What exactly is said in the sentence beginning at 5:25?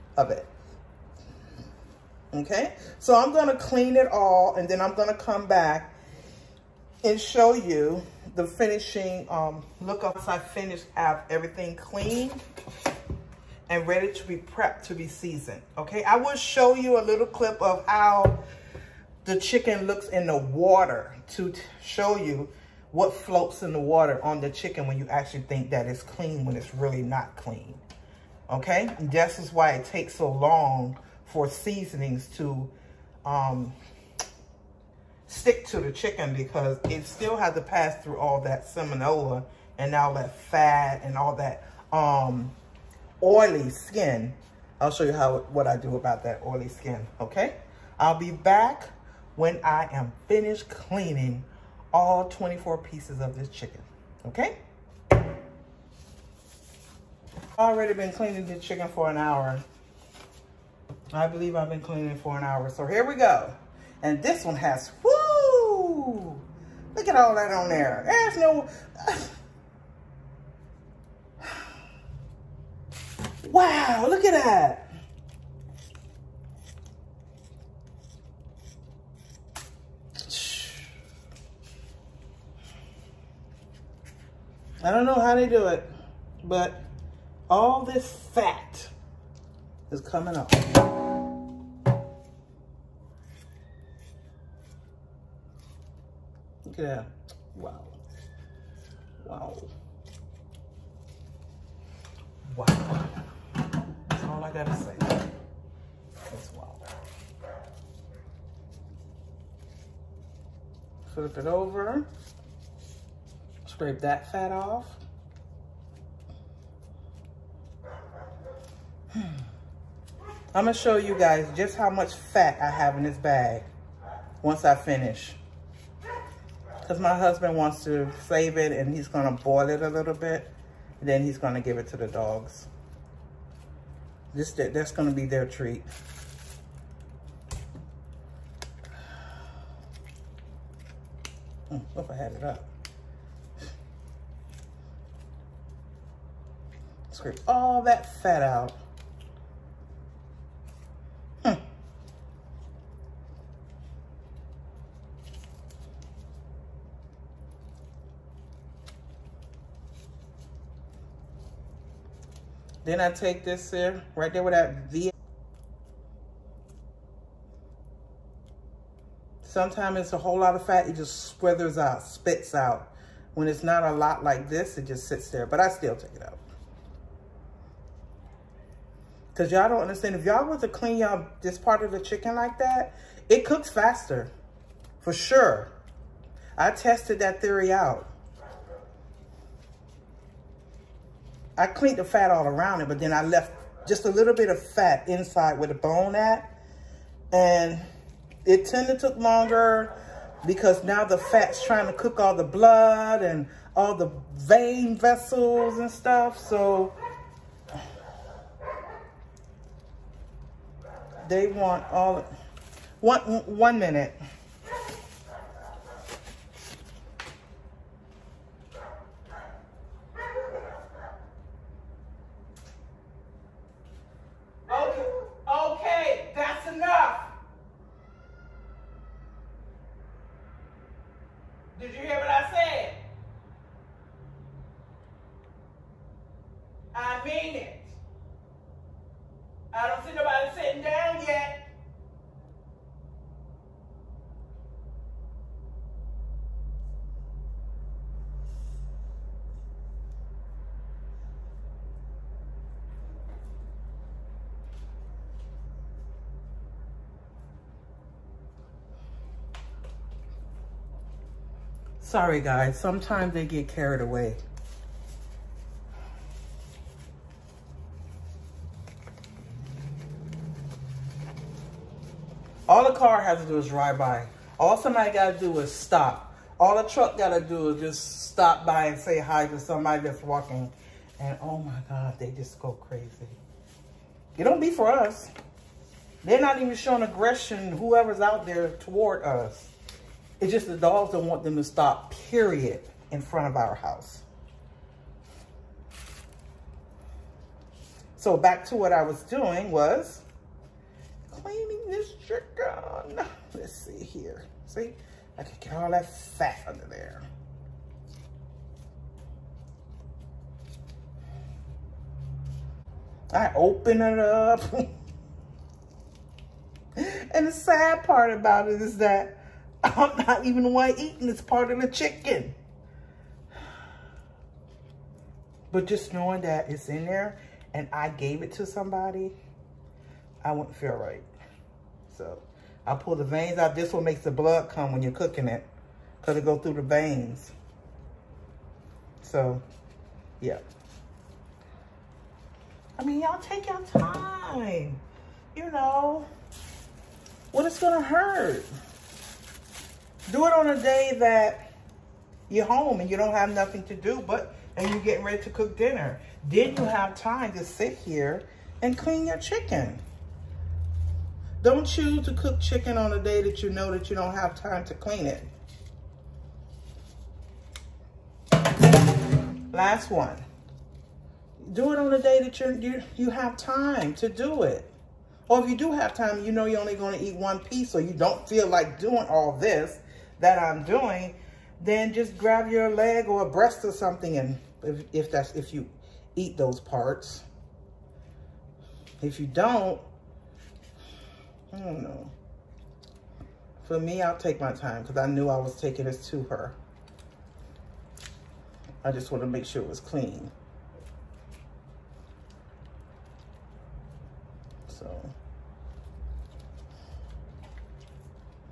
But just knowing that it's in there and I gave it to somebody, I wouldn't feel right.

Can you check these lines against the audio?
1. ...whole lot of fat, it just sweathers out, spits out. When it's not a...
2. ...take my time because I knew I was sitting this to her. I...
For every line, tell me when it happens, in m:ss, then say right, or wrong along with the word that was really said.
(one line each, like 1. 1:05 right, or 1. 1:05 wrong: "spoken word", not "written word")
1. 2:50 right
2. 6:34 wrong: "taking", not "sitting".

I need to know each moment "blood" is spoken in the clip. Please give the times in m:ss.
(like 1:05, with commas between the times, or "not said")
3:22, 5:34.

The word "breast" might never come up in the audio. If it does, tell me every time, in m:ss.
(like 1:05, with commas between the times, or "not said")
6:23.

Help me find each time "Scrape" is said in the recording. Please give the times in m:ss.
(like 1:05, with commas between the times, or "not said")
1:53, 2:27.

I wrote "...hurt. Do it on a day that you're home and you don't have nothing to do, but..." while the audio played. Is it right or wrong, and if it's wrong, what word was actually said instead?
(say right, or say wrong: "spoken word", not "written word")
right.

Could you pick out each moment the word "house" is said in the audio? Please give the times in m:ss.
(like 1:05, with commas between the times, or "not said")
4:53.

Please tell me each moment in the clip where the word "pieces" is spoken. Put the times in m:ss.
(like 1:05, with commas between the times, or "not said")
0:52, 6:17.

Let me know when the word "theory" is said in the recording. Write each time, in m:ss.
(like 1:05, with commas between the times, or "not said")
3:07.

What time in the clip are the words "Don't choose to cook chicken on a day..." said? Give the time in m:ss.
6:01.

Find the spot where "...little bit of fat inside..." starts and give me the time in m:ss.
3:14.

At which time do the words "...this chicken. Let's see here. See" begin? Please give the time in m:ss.
5:01.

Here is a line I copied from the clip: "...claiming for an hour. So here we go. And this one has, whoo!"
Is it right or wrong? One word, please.
wrong.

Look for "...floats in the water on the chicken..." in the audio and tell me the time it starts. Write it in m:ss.
0:23.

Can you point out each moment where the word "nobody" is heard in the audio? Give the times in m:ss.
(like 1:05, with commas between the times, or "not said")
4:00.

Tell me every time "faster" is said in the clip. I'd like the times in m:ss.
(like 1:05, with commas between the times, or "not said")
3:03.